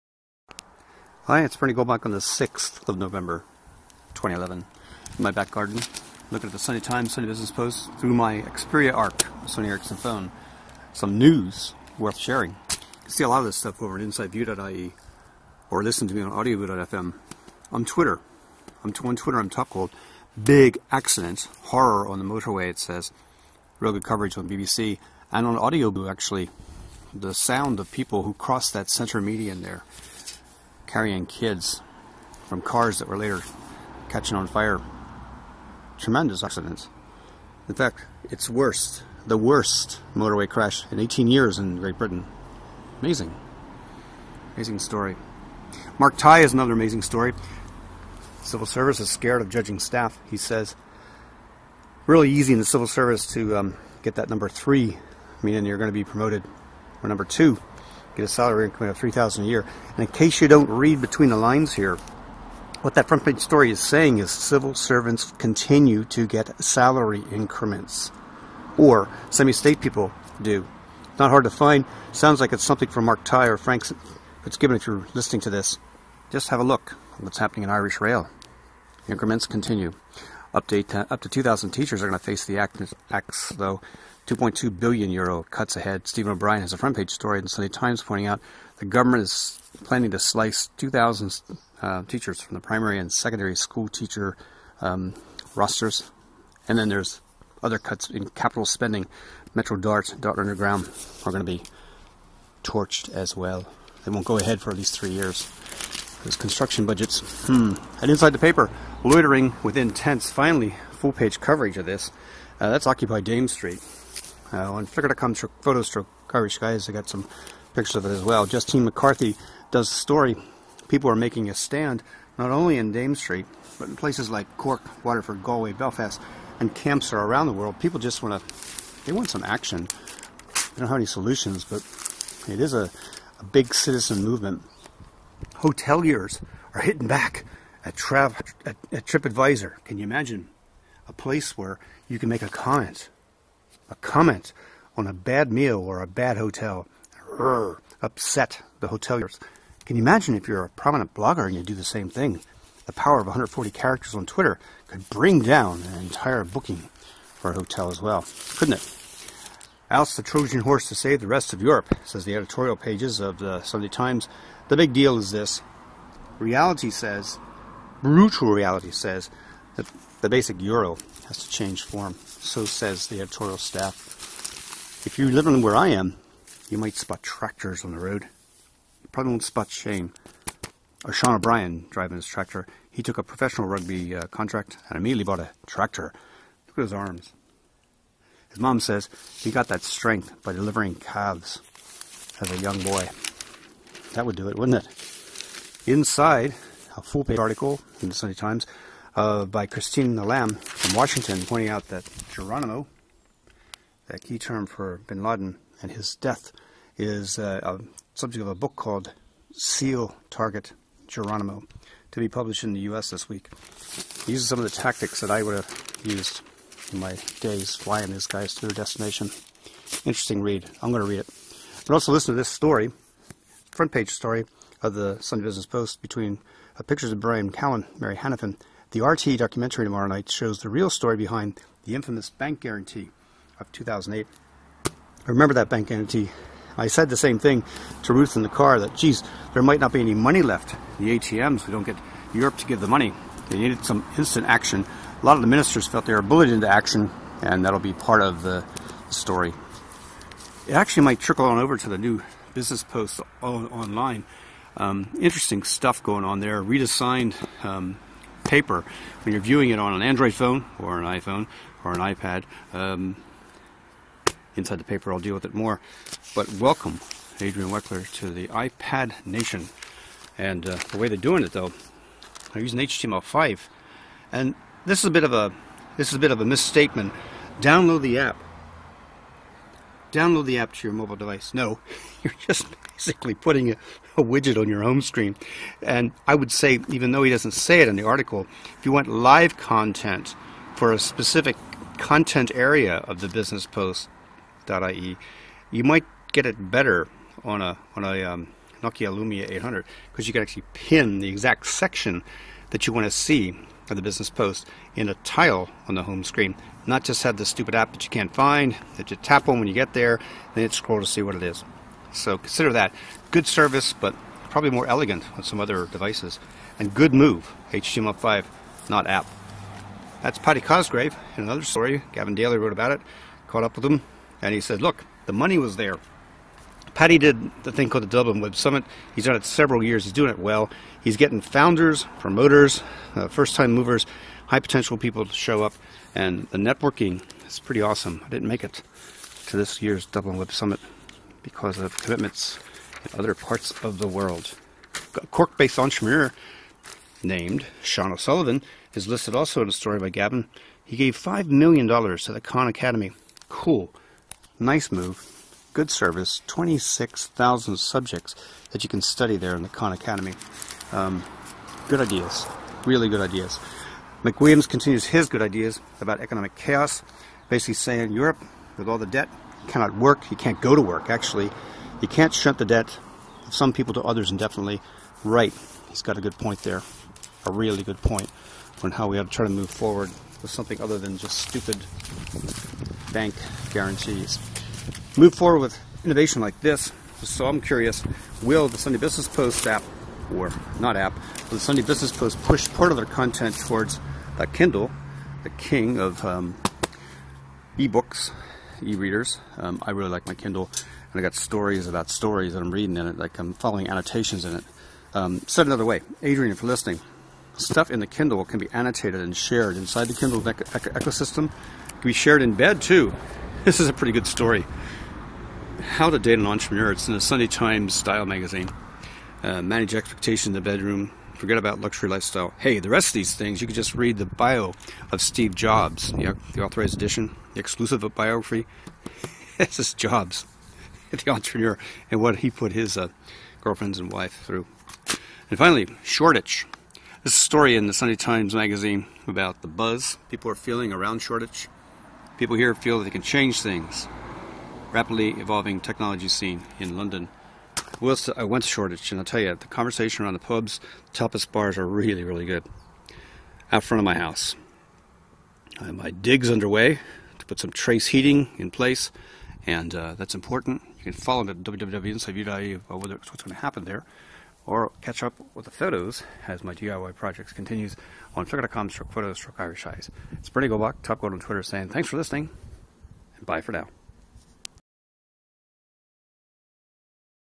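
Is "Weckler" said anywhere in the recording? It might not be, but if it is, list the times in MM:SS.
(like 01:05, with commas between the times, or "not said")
04:27.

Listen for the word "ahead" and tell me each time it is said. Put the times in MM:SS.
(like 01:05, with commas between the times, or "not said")
01:25, 01:44.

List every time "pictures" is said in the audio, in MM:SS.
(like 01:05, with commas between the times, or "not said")
01:57, 03:46.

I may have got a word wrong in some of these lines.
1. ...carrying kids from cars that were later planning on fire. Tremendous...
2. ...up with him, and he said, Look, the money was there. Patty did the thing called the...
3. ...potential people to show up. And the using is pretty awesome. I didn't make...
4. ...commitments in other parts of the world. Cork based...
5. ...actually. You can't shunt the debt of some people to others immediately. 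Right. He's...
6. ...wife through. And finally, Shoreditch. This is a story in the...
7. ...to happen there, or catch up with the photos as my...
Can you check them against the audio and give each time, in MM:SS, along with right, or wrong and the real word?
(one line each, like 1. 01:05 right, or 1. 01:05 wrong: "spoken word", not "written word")
1. 00:30 wrong: "catching", not "planning"
2. 05:23 right
3. 05:34 wrong: "networking", not "using"
4. 05:42 right
5. 06:11 wrong: "indefinitely", not "immediately"
6. 07:14 right
7. 07:43 right.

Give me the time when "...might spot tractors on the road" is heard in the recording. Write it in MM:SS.
02:56.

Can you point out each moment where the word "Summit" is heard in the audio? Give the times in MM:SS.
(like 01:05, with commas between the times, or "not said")
05:28, 05:40.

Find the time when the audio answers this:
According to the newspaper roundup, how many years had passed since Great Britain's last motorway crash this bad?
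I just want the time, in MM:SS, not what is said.
00:40.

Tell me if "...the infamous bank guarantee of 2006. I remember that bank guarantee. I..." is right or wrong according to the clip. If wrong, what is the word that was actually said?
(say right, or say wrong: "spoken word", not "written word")
wrong: "2008", not "2006".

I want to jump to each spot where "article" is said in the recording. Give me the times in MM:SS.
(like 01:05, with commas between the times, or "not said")
03:17, 04:48.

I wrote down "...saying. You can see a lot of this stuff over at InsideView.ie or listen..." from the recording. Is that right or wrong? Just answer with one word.
wrong.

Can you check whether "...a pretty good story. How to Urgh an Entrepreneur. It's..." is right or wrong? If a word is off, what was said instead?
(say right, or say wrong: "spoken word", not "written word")
wrong: "Date", not "Urgh".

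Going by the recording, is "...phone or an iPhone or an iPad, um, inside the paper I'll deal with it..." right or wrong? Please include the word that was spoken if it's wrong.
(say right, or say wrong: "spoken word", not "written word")
right.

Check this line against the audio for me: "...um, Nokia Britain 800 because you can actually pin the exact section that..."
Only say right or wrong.
wrong.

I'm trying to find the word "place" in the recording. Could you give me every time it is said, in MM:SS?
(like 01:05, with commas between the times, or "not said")
02:03, 02:21, 07:38.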